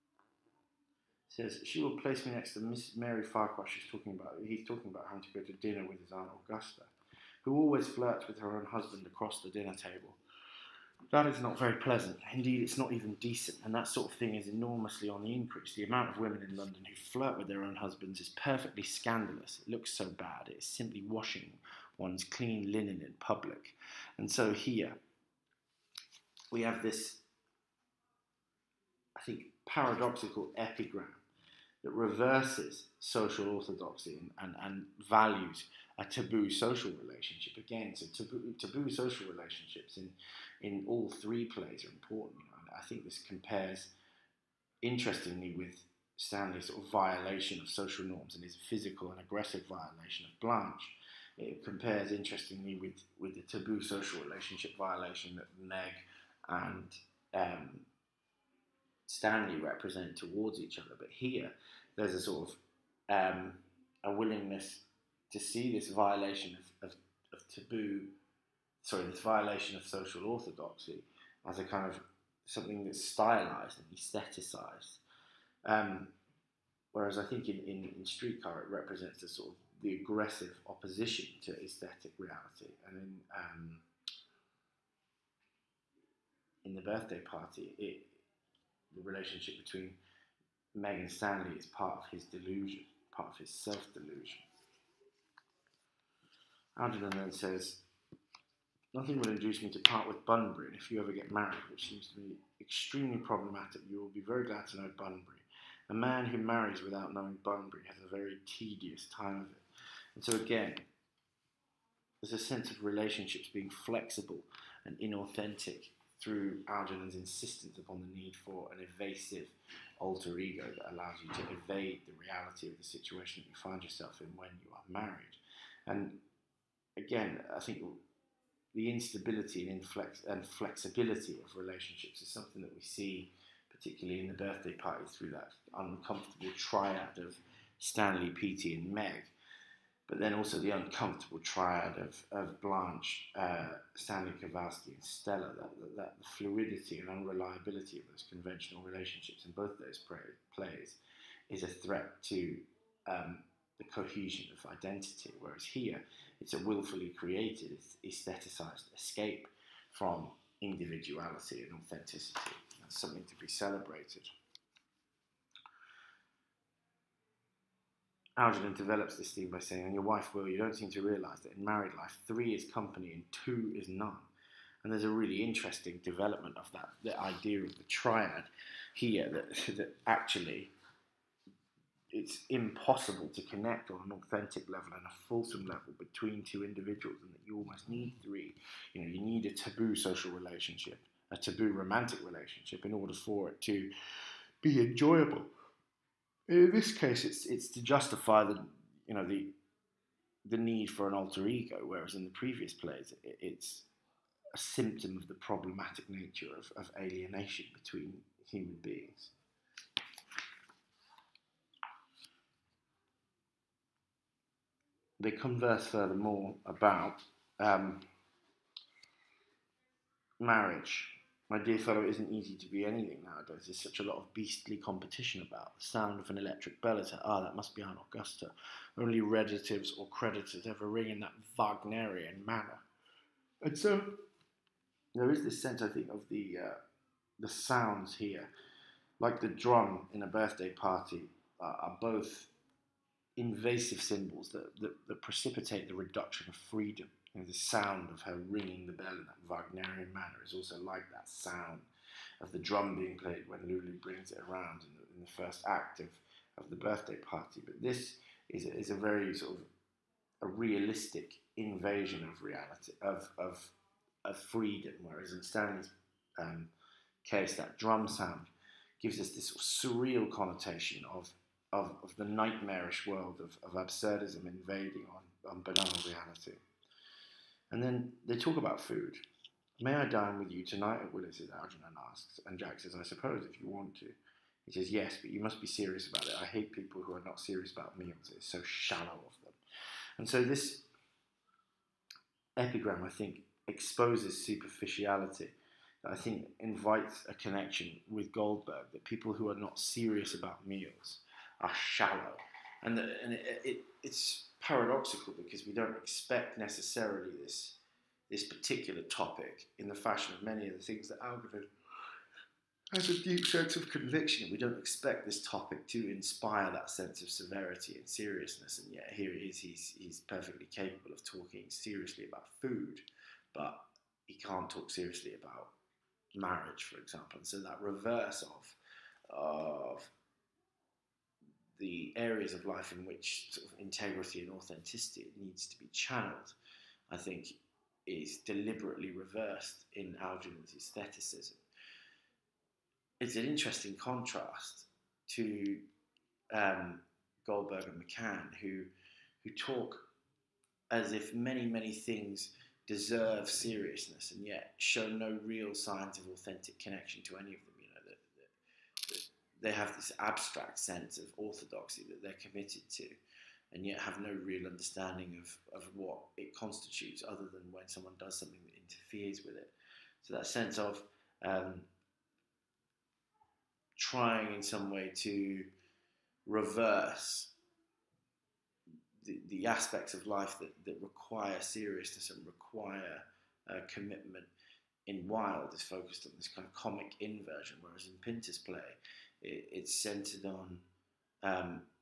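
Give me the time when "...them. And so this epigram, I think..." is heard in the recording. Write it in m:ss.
4:49.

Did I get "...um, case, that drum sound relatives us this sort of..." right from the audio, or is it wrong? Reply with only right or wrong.
wrong.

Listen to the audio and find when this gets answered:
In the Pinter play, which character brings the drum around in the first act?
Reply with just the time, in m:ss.
4:13.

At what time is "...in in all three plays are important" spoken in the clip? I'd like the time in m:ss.
0:39.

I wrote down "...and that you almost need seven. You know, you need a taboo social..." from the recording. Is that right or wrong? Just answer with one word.
wrong.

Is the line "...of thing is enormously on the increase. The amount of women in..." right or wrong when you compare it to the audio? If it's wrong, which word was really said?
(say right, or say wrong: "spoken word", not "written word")
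right.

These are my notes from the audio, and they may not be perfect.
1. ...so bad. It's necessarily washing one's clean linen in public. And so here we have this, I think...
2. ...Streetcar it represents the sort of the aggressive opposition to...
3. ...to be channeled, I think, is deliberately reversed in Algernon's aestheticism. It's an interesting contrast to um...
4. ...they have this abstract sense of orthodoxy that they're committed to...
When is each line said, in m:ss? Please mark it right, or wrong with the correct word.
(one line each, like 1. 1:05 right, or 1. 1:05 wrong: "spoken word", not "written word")
1. 0:19 wrong: "simply", not "necessarily"
2. 1:18 right
3. 5:35 right
4. 5:59 right.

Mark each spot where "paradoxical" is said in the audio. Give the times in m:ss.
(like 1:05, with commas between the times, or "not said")
0:29, 5:04.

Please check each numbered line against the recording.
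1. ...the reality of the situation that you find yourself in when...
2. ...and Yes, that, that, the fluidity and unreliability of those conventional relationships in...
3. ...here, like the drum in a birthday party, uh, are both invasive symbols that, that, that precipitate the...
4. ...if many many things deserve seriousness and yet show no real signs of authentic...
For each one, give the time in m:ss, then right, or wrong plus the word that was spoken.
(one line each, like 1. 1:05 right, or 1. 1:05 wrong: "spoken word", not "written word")
1. 2:02 right
2. 2:24 wrong: "Stella", not "Yes"
3. 3:58 right
4. 5:51 right.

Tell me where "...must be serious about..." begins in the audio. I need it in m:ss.
4:45.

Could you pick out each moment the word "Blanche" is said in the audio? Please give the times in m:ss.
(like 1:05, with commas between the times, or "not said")
0:50, 2:22.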